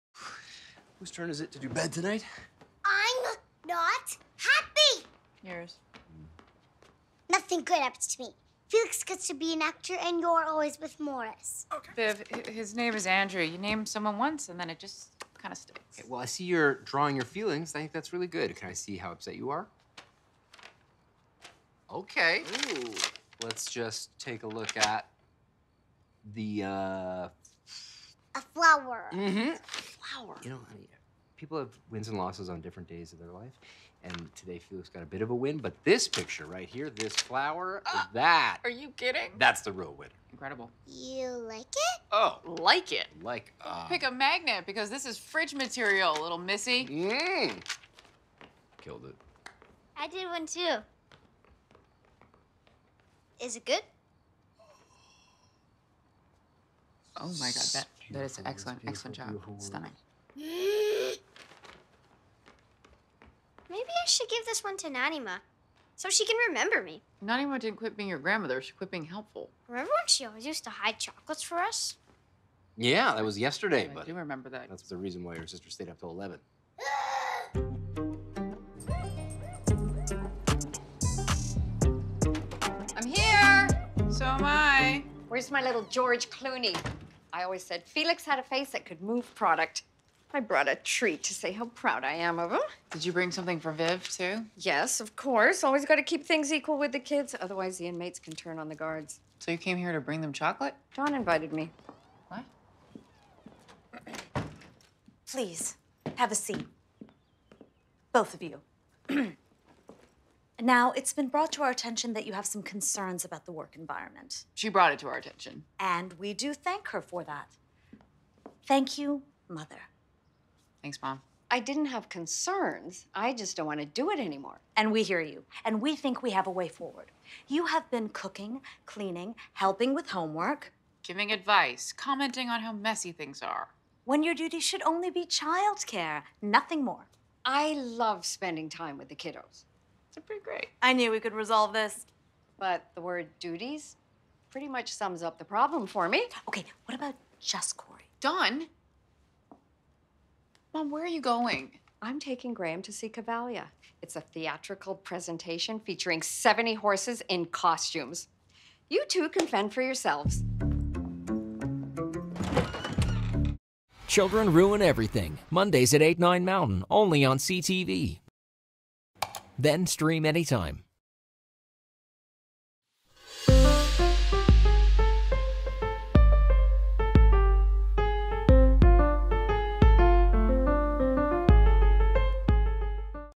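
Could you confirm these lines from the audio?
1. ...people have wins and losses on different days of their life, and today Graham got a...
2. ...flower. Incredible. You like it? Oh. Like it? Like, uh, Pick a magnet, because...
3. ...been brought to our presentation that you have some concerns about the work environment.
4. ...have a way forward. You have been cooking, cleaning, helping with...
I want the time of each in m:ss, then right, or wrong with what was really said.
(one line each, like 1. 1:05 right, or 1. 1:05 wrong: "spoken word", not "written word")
1. 0:31 wrong: "Felix", not "Graham"
2. 0:39 wrong: "winner", not "flower"
3. 1:51 wrong: "attention", not "presentation"
4. 2:06 right.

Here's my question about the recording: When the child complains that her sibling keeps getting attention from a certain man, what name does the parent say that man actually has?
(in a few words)
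Andrew.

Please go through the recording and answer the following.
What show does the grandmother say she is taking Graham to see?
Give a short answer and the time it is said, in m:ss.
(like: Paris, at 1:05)
Cavalia, at 2:33.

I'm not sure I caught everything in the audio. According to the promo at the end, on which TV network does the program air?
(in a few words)
CTV.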